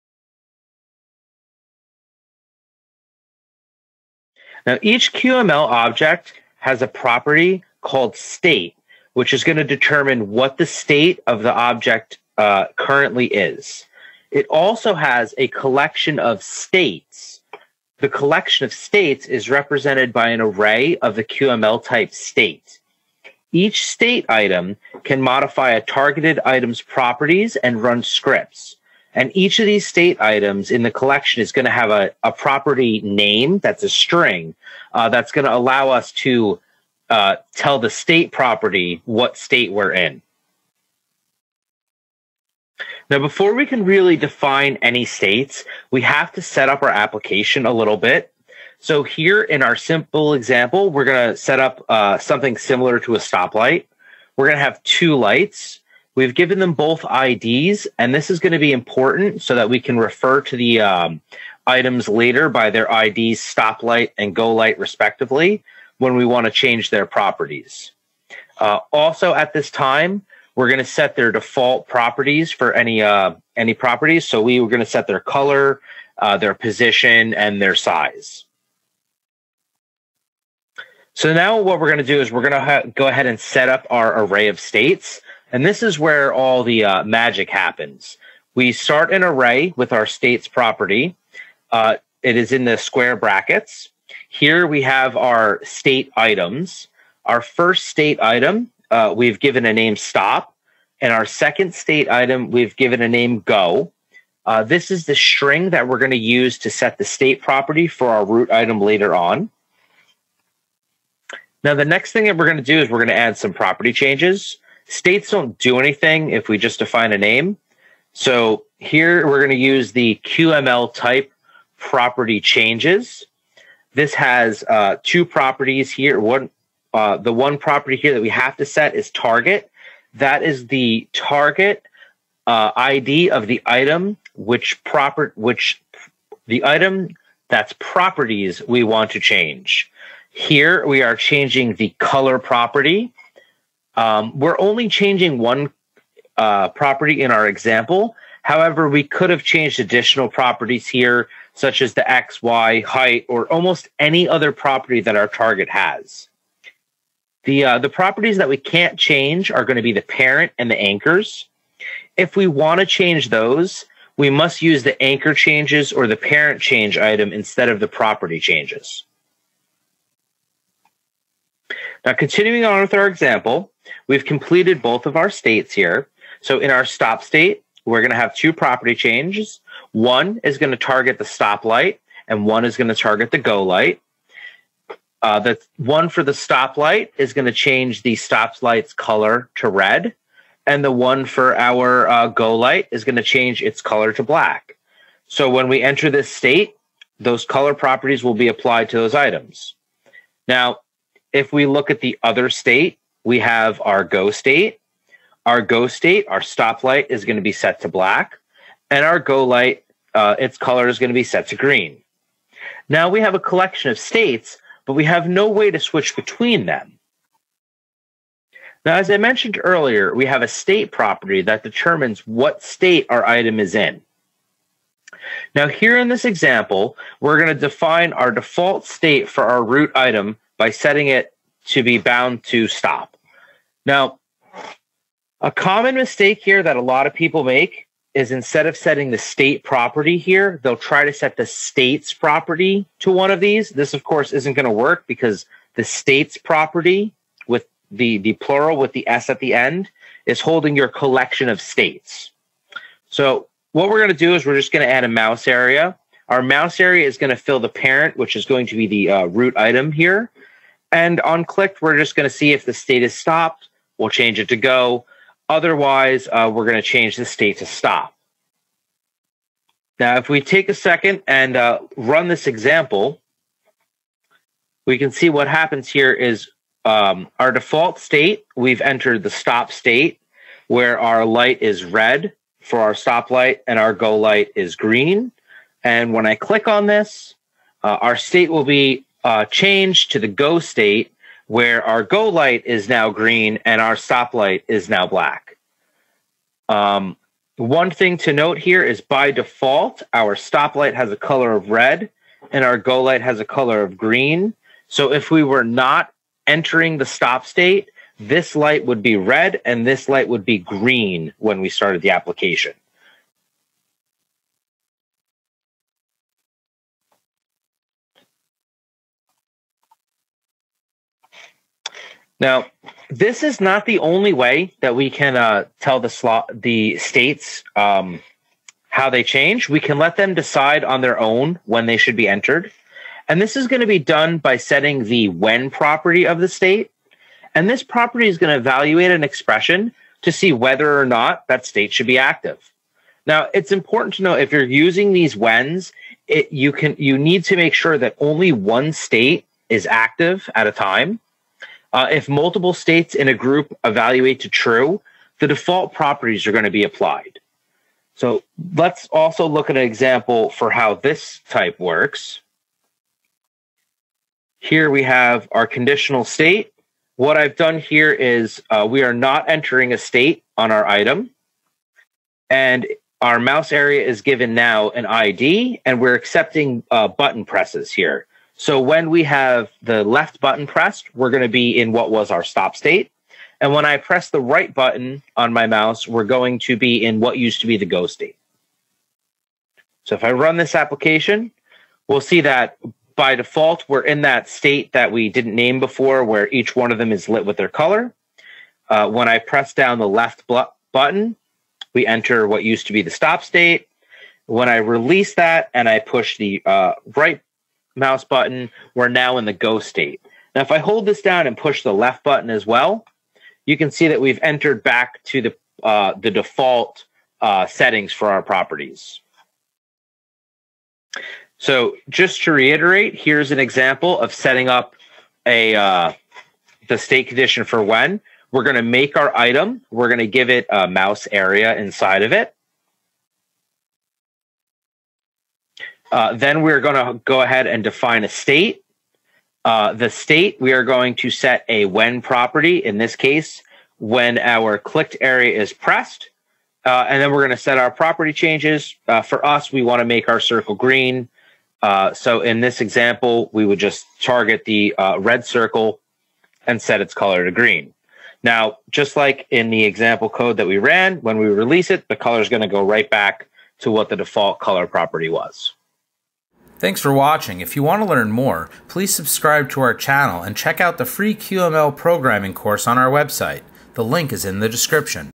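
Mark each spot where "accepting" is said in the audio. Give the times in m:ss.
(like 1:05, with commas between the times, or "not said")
6:16.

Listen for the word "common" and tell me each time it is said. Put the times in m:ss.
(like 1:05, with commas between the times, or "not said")
3:55.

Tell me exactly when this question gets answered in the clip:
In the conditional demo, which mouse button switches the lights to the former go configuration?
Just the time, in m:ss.
6:24.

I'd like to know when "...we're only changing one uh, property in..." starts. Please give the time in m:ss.
2:24.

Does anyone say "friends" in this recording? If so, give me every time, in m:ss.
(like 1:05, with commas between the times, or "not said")
not said.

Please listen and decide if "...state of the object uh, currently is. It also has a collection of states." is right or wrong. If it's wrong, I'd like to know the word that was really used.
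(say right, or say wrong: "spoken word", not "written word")
right.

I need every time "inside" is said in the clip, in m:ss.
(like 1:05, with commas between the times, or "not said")
7:11.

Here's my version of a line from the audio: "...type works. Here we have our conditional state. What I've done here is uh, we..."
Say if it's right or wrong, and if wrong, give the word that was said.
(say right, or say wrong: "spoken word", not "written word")
right.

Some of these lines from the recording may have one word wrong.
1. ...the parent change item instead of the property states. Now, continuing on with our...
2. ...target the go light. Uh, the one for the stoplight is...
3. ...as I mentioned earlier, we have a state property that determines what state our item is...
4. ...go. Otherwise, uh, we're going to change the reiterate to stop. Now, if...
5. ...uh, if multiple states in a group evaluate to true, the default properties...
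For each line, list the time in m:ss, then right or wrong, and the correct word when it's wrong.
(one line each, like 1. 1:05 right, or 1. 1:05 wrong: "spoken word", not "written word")
1. 2:46 wrong: "changes", not "states"
2. 3:02 right
3. 3:38 right
4. 4:24 wrong: "state", not "reiterate"
5. 5:51 right.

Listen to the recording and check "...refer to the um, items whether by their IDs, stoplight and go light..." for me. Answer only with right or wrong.
wrong.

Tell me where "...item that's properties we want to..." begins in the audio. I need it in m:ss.
2:16.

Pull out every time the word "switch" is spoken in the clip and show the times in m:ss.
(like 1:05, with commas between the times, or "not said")
3:35.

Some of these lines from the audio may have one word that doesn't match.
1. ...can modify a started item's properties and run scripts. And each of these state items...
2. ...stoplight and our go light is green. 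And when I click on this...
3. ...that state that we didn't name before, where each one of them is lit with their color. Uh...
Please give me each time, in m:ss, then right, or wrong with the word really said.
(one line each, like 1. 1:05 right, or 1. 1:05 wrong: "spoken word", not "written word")
1. 0:25 wrong: "targeted", not "started"
2. 4:42 right
3. 6:34 right.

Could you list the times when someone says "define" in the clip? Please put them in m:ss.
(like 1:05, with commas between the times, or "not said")
0:44, 1:56, 3:47, 7:17.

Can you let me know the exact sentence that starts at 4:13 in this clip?
So what we're going to do is we're just going to add a mouse area.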